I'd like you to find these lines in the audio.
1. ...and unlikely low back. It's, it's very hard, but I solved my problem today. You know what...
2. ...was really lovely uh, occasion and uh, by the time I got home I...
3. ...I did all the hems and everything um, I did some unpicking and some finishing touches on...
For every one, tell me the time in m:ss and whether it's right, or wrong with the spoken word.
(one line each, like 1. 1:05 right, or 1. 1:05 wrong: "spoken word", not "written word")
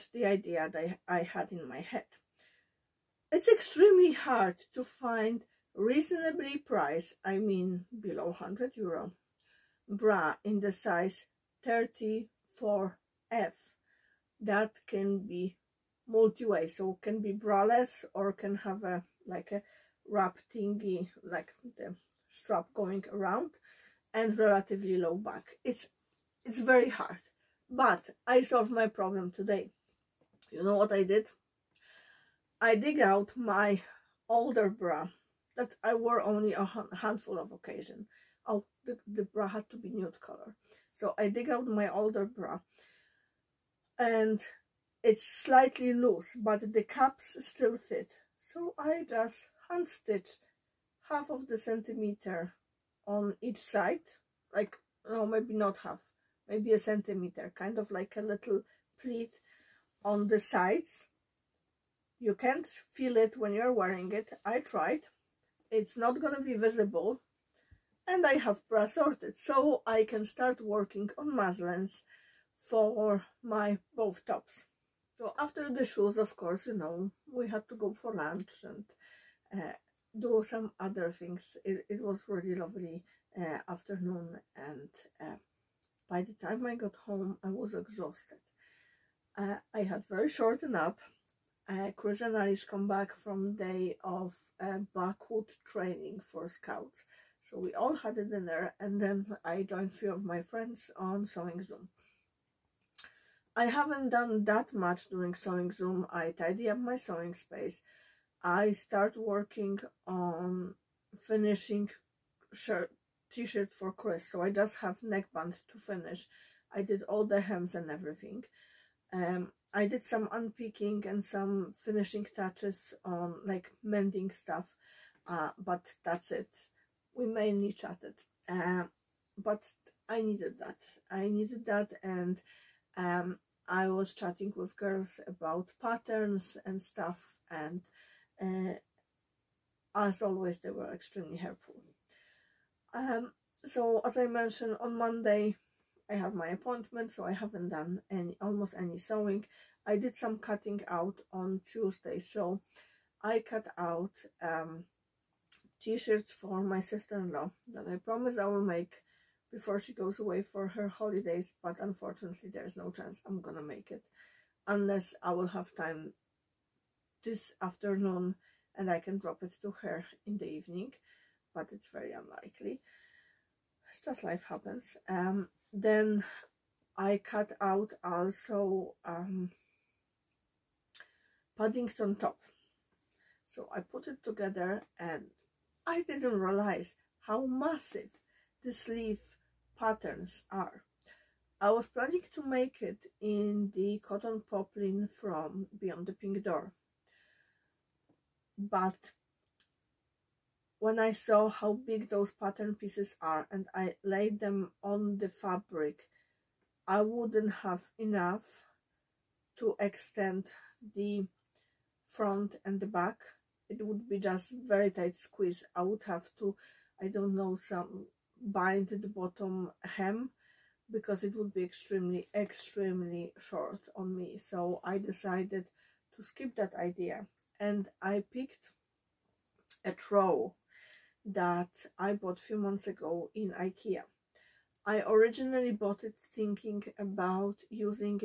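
1. 0:24 wrong: "relatively", not "unlikely"
2. 1:22 wrong: "afternoon", not "occasion"
3. 1:56 right.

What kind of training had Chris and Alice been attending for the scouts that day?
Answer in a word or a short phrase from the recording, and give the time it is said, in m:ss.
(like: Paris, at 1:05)
backwood training, at 1:34.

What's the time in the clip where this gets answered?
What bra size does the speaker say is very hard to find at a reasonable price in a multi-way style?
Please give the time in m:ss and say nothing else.
0:11.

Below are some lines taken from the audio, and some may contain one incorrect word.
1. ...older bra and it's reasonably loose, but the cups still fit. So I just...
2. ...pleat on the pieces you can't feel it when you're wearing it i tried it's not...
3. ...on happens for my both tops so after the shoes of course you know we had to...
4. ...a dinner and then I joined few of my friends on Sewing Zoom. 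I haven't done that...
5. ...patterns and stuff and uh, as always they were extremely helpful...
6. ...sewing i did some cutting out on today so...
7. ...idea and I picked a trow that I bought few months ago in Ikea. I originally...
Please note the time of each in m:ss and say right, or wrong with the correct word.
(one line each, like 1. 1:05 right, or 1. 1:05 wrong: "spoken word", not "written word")
1. 0:41 wrong: "slightly", not "reasonably"
2. 0:59 wrong: "sides", not "pieces"
3. 1:11 wrong: "muslins", not "happens"
4. 1:38 right
5. 2:15 right
6. 2:28 wrong: "tuesday", not "today"
7. 3:46 right.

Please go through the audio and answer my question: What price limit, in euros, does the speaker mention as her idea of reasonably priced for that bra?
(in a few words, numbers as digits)
100 euro.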